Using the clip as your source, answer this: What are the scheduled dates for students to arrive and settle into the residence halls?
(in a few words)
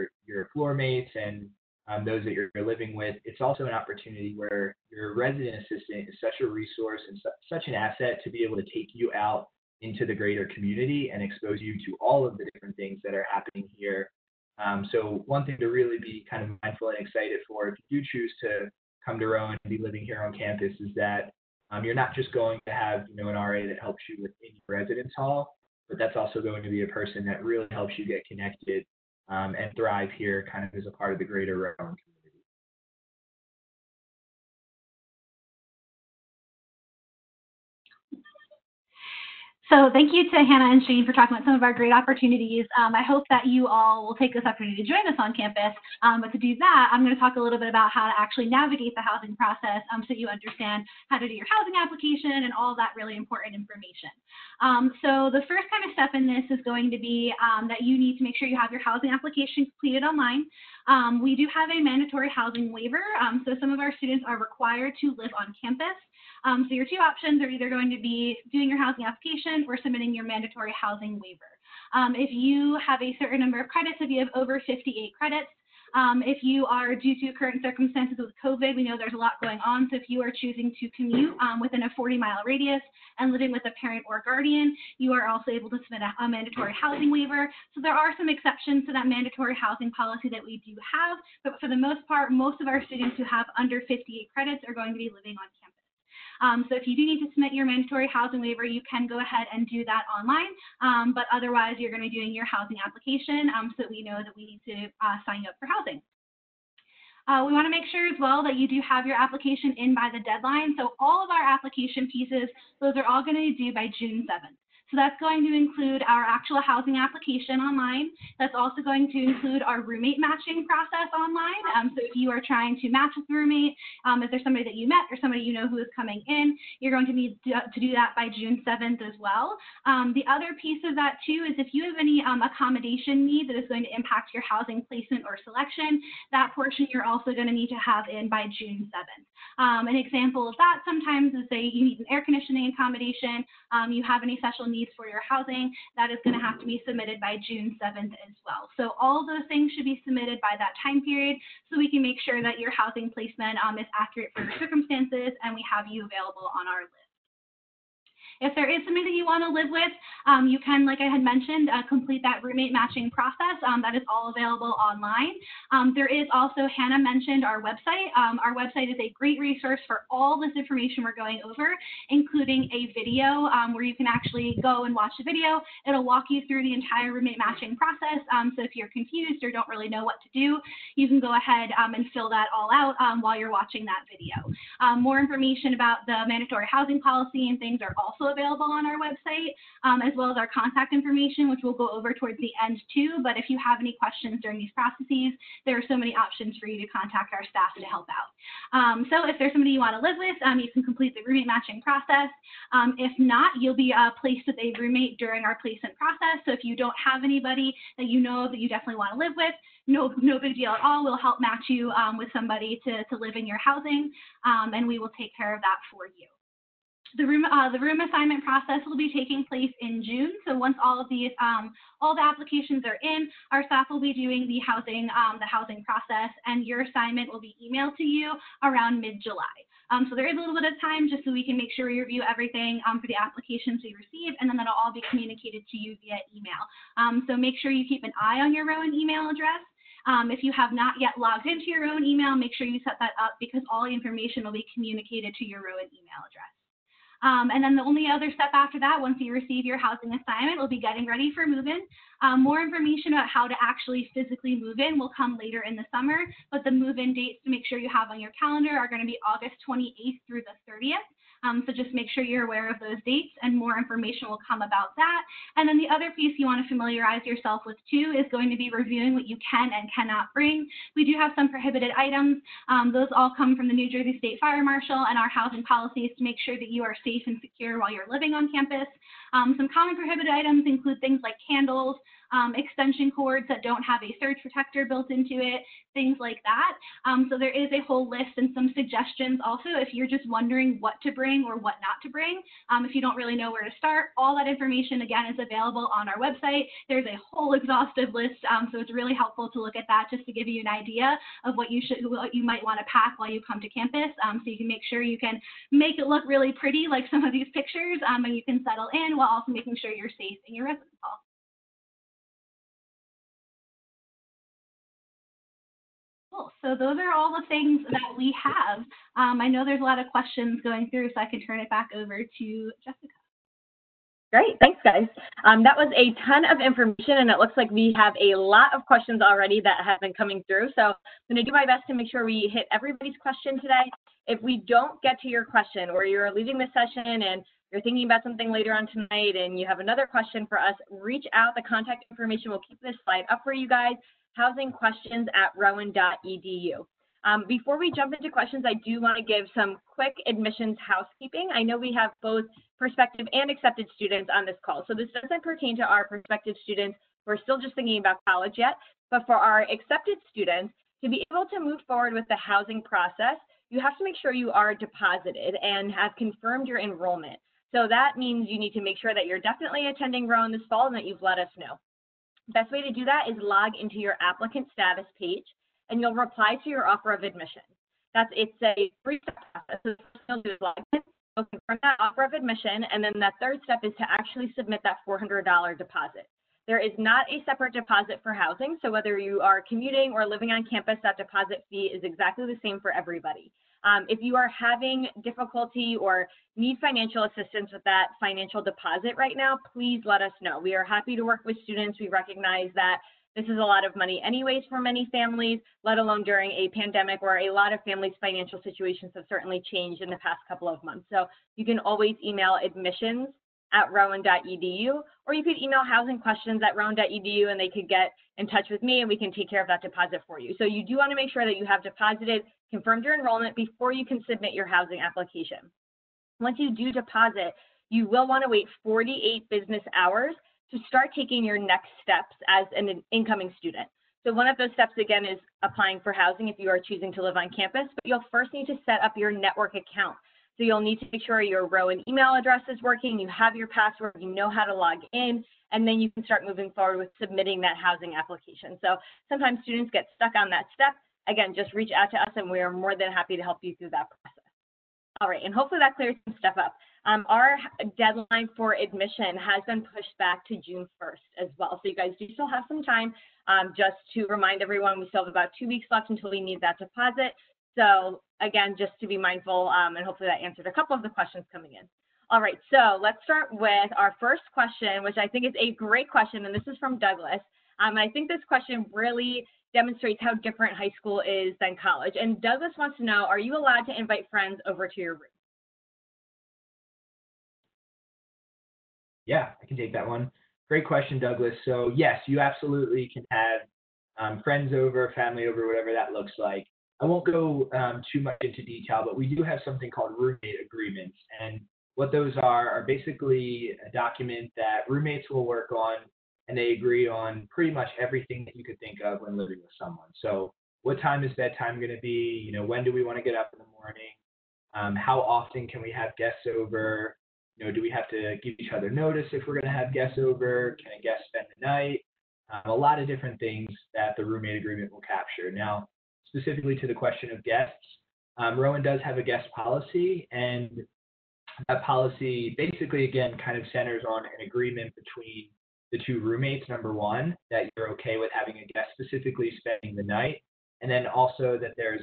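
August 28th through 30th.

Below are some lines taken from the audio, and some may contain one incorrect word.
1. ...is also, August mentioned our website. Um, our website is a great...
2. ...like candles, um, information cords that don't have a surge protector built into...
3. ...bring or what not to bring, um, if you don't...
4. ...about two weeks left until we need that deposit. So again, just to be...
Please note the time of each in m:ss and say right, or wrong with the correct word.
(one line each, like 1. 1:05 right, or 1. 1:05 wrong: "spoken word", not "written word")
1. 2:46 wrong: "Hannah", not "August"
2. 4:41 wrong: "extension", not "information"
3. 4:51 right
4. 7:45 right.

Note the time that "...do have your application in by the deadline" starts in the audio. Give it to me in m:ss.
1:48.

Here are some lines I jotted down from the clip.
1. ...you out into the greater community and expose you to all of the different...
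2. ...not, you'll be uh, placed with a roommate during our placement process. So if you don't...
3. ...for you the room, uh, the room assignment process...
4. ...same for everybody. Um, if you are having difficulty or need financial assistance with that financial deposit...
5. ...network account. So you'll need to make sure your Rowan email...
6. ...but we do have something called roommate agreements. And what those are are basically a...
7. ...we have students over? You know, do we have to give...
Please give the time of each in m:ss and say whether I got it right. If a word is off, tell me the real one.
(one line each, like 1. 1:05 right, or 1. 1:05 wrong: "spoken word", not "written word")
1. 0:08 right
2. 3:23 right
3. 3:35 right
4. 6:32 right
5. 7:19 right
6. 8:19 right
7. 8:35 wrong: "guests", not "students".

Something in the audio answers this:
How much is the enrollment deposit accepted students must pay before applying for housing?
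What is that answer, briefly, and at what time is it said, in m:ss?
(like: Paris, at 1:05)
$400, at 6:25.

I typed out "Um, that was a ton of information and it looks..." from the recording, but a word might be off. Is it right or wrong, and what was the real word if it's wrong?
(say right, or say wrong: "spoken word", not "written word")
right.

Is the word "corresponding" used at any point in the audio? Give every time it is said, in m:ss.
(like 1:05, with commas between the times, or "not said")
not said.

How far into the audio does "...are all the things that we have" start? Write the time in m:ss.
5:16.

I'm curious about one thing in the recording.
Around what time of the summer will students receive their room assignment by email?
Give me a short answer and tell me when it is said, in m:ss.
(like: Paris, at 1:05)
Mid-July, at 3:49.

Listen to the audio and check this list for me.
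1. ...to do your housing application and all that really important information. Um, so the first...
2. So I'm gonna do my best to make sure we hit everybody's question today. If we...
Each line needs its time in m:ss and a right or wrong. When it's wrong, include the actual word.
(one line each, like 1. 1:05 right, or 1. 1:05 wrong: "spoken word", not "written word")
1. 0:51 right
2. 5:30 right.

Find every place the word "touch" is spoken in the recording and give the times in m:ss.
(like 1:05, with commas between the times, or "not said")
6:58.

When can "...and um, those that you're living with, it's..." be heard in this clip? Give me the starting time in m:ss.
0:01.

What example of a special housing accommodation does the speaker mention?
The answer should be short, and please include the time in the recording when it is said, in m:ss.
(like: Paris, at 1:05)
Air conditioning, at 2:22.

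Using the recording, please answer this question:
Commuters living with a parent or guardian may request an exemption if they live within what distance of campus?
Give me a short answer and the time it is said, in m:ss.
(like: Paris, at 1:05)
40 miles, at 1:21.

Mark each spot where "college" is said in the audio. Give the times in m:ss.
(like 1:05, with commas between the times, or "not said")
5:58, 8:01.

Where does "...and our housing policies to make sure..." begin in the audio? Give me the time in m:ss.
4:35.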